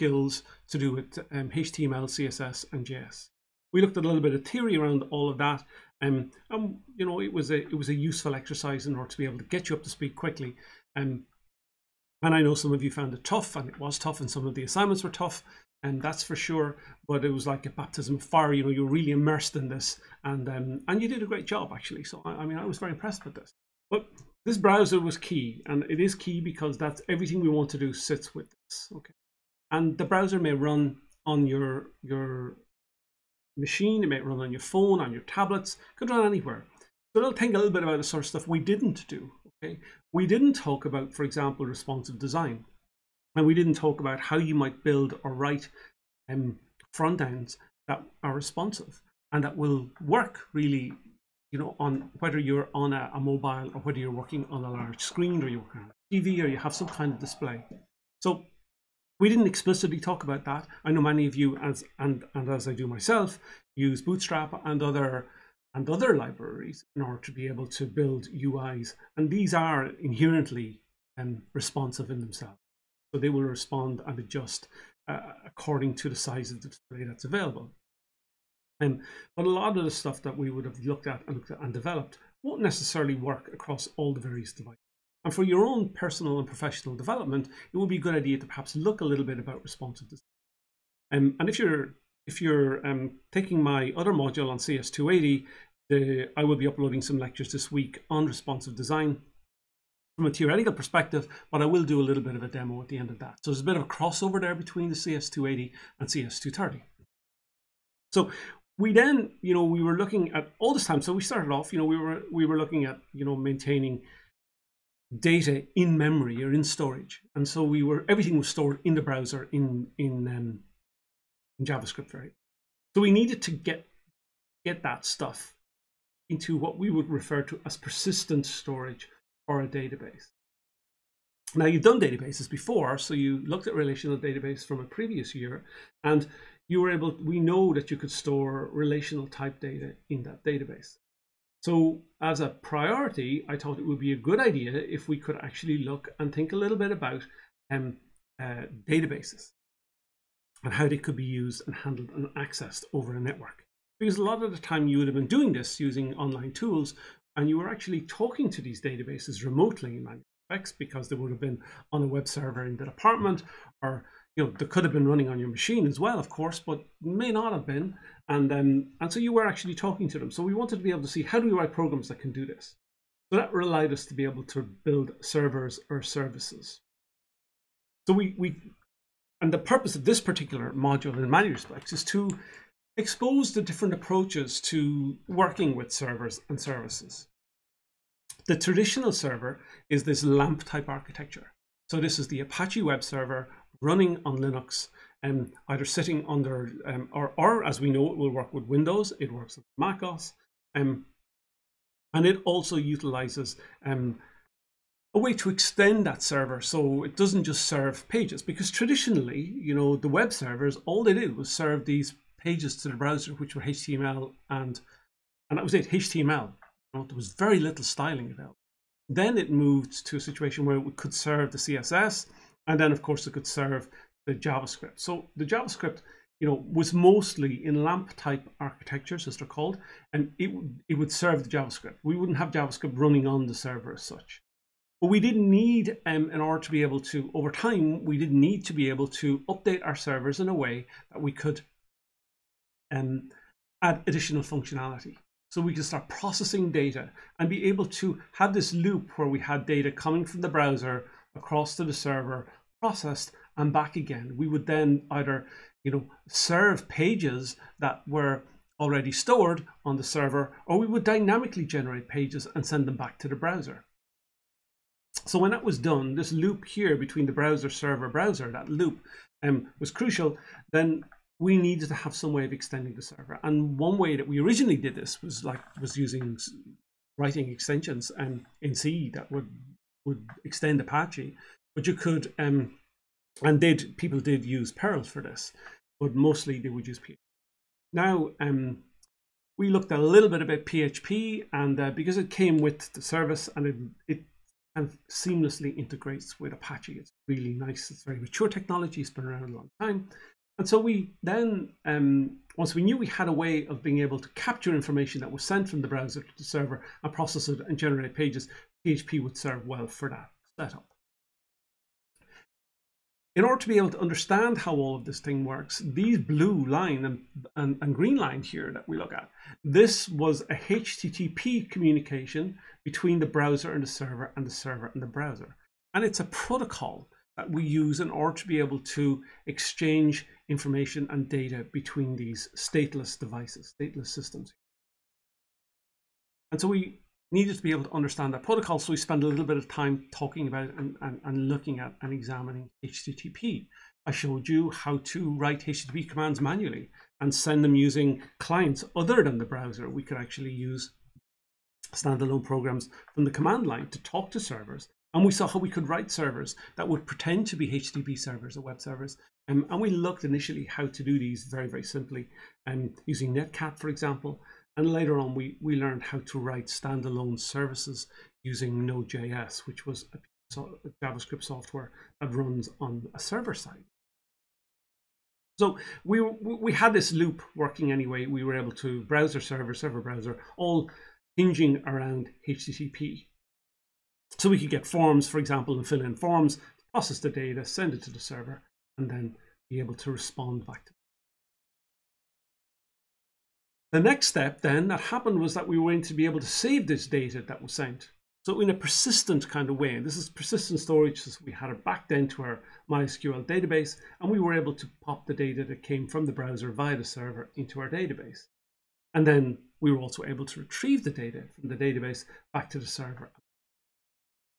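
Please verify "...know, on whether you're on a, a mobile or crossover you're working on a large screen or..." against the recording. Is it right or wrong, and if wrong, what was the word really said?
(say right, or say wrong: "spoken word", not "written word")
wrong: "whether", not "crossover".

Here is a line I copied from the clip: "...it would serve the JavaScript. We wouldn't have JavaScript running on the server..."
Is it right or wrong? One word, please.
right.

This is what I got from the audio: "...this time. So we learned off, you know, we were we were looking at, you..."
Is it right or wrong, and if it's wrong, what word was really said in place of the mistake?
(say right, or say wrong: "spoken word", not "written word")
wrong: "started", not "learned".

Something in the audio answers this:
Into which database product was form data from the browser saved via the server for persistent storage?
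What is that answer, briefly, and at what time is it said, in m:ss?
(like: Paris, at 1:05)
MySQL, at 6:42.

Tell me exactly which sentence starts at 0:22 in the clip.
So I, I mean, I was very impressed with this.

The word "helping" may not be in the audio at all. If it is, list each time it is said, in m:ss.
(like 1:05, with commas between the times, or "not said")
not said.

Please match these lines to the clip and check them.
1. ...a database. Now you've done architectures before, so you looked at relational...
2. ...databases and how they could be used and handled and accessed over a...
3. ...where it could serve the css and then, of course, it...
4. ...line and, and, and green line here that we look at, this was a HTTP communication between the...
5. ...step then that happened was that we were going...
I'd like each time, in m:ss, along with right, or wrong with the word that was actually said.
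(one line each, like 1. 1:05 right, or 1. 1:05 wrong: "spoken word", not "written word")
1. 2:09 wrong: "databases", not "architectures"
2. 2:28 right
3. 3:40 right
4. 5:16 right
5. 6:34 right.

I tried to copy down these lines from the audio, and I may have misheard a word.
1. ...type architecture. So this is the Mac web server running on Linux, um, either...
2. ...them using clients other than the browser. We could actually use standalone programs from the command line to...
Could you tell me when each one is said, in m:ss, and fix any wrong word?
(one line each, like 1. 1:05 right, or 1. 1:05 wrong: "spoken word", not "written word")
1. 3:10 wrong: "Apache", not "Mac"
2. 5:47 right.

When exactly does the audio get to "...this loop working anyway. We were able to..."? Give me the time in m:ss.
6:16.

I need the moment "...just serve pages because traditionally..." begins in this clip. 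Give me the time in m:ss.
3:27.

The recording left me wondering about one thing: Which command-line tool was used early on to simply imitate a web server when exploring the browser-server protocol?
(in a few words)
Netcat.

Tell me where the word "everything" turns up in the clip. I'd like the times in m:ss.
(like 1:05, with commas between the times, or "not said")
0:27, 1:58.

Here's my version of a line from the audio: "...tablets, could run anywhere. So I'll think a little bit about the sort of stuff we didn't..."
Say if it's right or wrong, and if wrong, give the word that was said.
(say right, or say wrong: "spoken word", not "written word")
right.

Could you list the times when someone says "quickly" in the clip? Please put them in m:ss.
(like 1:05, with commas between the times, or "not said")
0:10.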